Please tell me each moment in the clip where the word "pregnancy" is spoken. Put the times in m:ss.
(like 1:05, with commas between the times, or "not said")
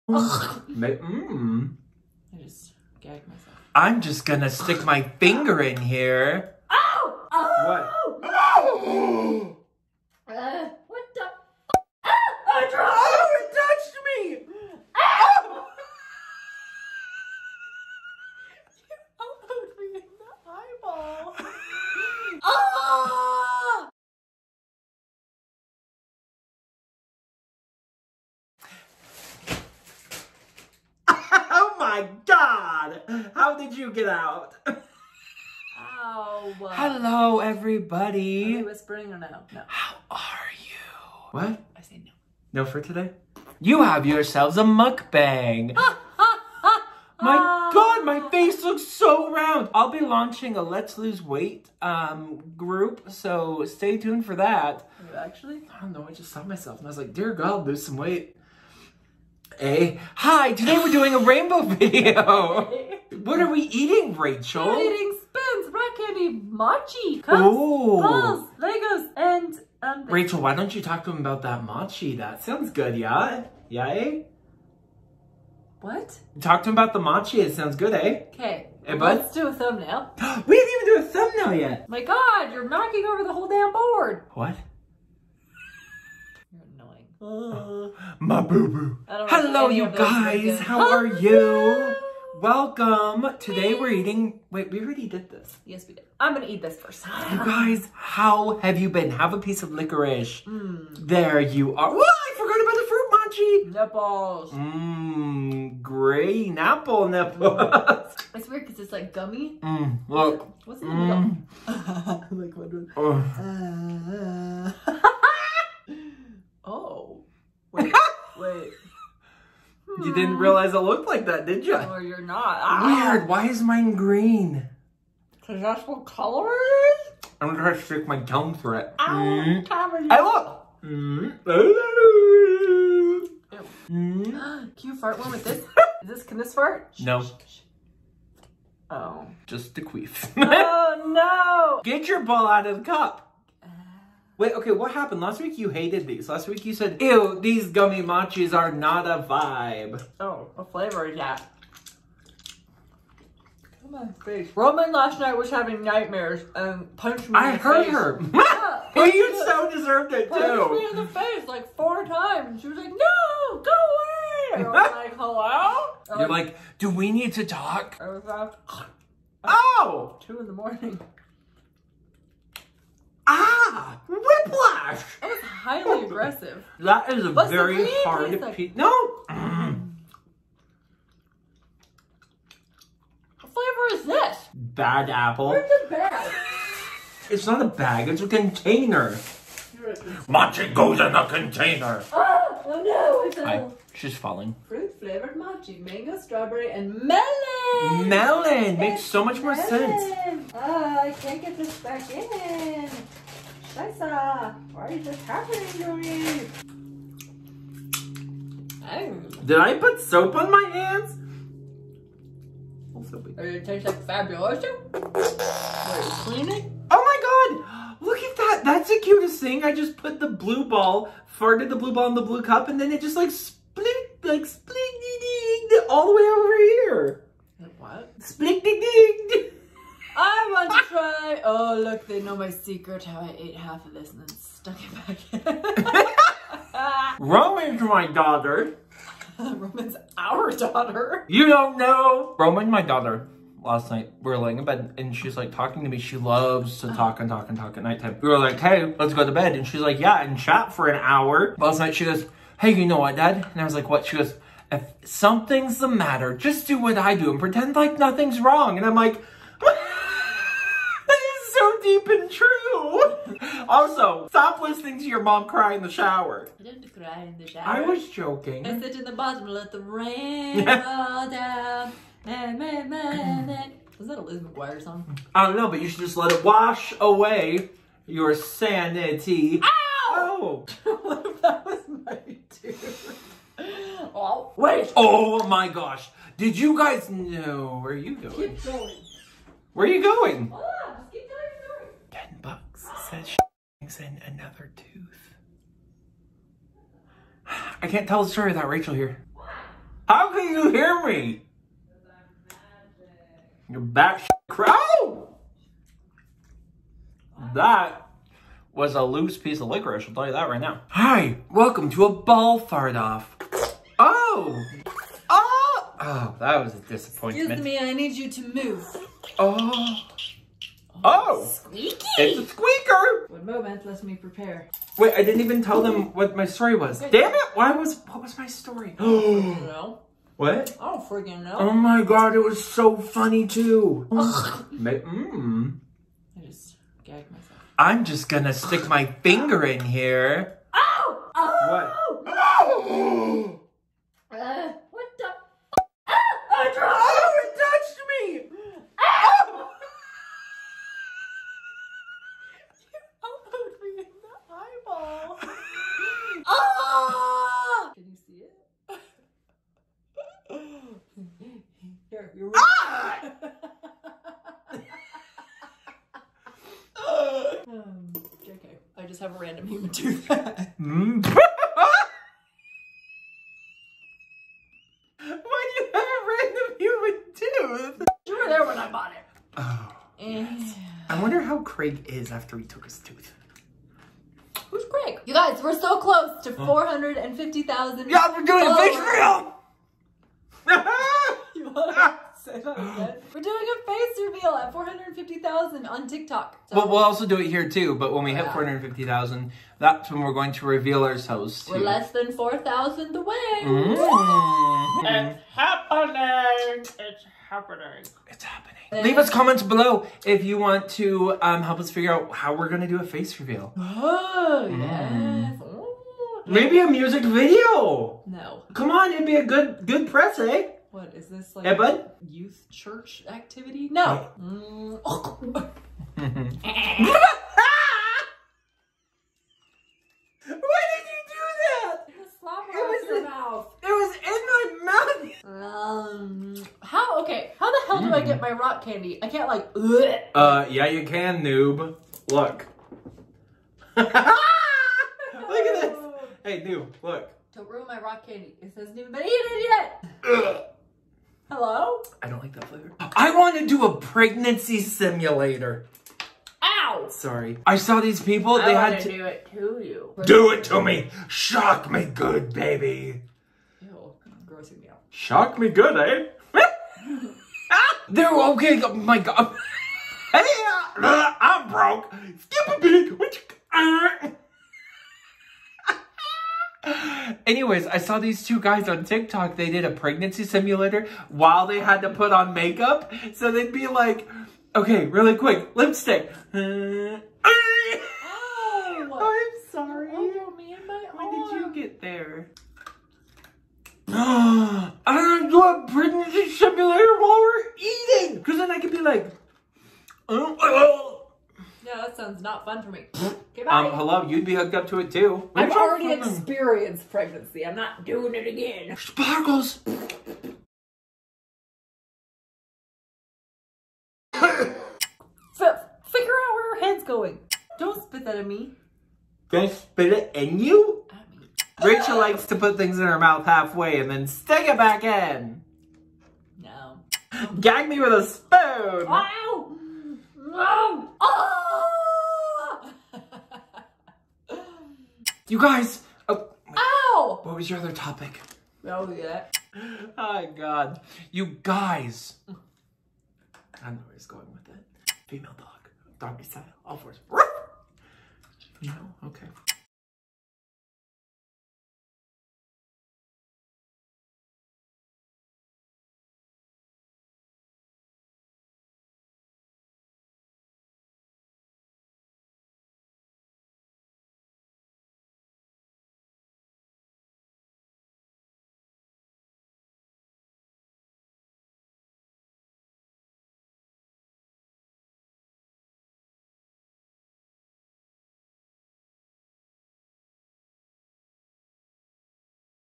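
7:33, 7:59, 8:15, 8:27.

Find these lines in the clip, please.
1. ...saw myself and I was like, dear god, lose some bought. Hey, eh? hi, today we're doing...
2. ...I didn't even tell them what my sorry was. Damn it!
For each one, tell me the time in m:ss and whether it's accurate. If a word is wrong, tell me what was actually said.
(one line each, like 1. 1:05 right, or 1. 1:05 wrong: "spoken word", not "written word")
1. 0:56 wrong: "weight", not "bought"
2. 5:25 wrong: "story", not "sorry".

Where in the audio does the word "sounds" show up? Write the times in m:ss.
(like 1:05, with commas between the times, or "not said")
1:12, 1:17, 8:22.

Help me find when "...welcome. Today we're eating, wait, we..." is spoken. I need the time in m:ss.
1:32.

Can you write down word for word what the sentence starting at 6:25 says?
You guys, we're so close to huh?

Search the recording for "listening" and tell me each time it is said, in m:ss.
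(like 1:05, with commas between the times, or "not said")
4:24.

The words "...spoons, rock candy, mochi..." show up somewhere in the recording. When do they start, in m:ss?
1:05.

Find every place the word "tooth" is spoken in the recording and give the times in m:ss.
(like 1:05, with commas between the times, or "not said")
4:54, 6:17, 6:22.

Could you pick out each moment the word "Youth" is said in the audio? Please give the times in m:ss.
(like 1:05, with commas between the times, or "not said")
7:02.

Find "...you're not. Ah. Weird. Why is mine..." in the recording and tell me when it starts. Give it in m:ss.
2:01.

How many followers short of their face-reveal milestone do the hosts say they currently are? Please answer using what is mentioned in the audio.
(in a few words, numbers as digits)
Less than 4,000.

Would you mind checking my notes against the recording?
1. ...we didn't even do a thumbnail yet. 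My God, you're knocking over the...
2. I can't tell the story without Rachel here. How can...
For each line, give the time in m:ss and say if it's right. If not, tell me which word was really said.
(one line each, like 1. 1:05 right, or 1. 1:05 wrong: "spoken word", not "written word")
1. 1:20 right
2. 4:57 right.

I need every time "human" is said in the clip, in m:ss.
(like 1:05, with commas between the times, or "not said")
6:09, 6:16.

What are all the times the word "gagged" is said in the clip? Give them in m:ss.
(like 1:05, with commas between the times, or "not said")
0:03, 5:37.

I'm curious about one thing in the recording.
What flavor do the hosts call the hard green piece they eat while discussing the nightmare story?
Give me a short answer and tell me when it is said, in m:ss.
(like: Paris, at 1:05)
Bad apple, at 3:04.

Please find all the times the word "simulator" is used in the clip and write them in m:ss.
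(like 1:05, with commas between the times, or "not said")
7:34, 8:00, 8:16.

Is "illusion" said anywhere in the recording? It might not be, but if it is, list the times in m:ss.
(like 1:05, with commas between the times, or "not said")
not said.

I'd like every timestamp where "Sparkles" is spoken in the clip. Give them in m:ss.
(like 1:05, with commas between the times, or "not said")
8:28.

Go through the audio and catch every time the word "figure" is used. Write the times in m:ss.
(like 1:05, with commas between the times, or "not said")
6:51, 8:36.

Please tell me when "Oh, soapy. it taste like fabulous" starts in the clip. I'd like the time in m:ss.
3:32.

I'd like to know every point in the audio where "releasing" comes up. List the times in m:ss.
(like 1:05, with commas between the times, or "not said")
not said.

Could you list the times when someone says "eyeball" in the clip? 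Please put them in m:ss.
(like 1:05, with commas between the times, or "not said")
0:20.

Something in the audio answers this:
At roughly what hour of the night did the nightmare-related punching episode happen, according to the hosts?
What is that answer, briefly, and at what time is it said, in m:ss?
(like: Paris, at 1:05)
2 in the morning, at 2:50.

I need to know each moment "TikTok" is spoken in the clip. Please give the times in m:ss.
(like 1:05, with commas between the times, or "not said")
6:36, 7:59.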